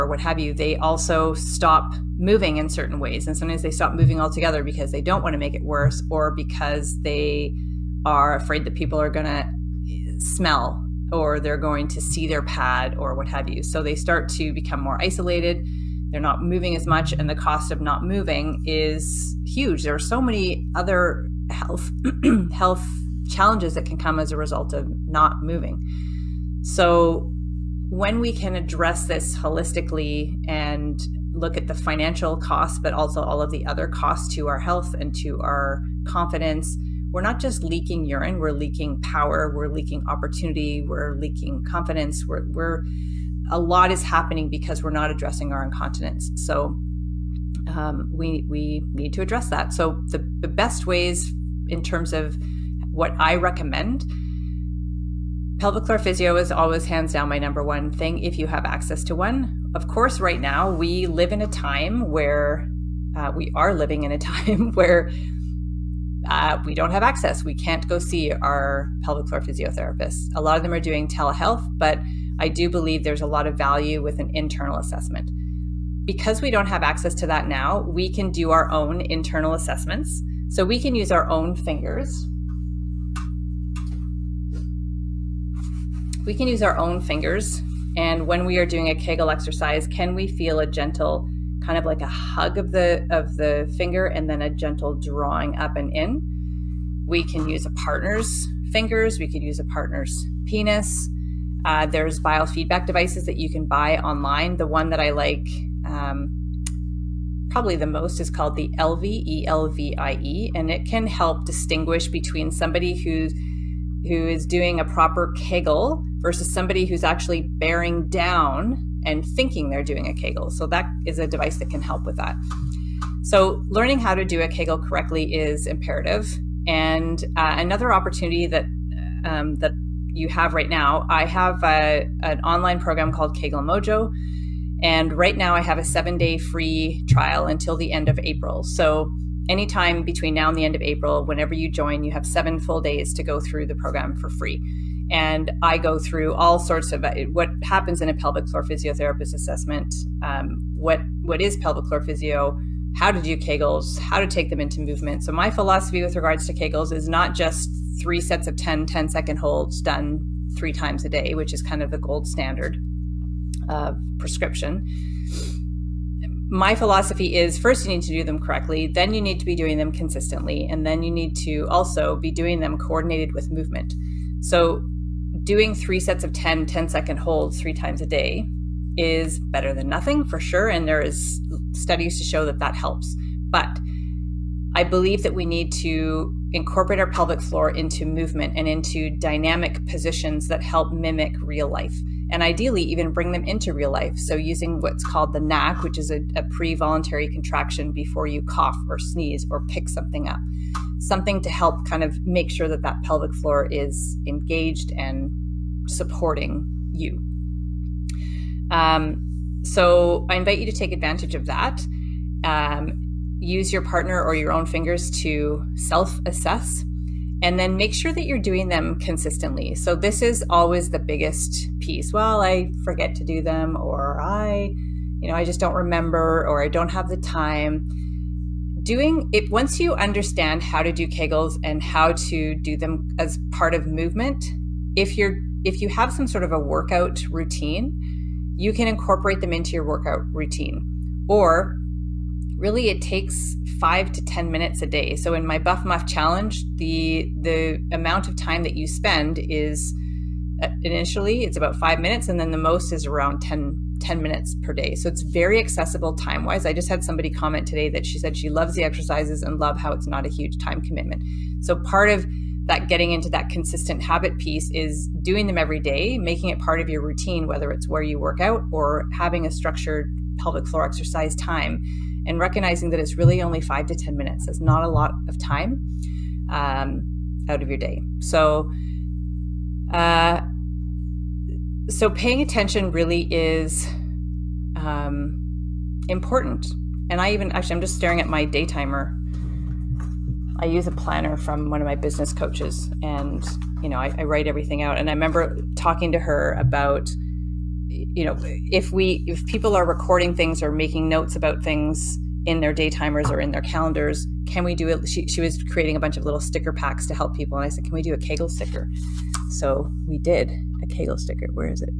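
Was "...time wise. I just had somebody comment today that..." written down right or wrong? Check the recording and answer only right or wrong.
right.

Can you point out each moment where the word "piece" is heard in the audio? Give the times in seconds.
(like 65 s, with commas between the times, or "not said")
221 s, 264 s.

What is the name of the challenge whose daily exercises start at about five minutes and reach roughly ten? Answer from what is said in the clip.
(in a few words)
Buff Muff Challenge.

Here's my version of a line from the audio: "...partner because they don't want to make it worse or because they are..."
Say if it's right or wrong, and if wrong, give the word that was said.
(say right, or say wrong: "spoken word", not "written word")
wrong: "altogether", not "partner".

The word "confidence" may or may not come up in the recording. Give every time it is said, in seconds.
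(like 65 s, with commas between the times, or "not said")
36 s, 41 s.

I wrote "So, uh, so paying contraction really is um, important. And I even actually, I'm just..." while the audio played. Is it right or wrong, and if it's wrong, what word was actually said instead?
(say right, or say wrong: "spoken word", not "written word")
wrong: "attention", not "contraction".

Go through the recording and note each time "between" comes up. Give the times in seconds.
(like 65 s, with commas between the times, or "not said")
112 s, 140 s.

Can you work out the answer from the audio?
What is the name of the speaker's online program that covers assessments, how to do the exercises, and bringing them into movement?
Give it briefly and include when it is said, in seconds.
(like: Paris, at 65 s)
Kegel Mojo, at 133 s.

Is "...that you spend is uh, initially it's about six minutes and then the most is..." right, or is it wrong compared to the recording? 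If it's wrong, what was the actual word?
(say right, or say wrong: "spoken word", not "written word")
wrong: "five", not "six".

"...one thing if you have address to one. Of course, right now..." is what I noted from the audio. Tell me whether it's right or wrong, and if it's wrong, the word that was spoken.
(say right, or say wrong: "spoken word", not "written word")
wrong: "access", not "address".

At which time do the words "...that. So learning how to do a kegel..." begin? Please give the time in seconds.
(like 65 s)
122 s.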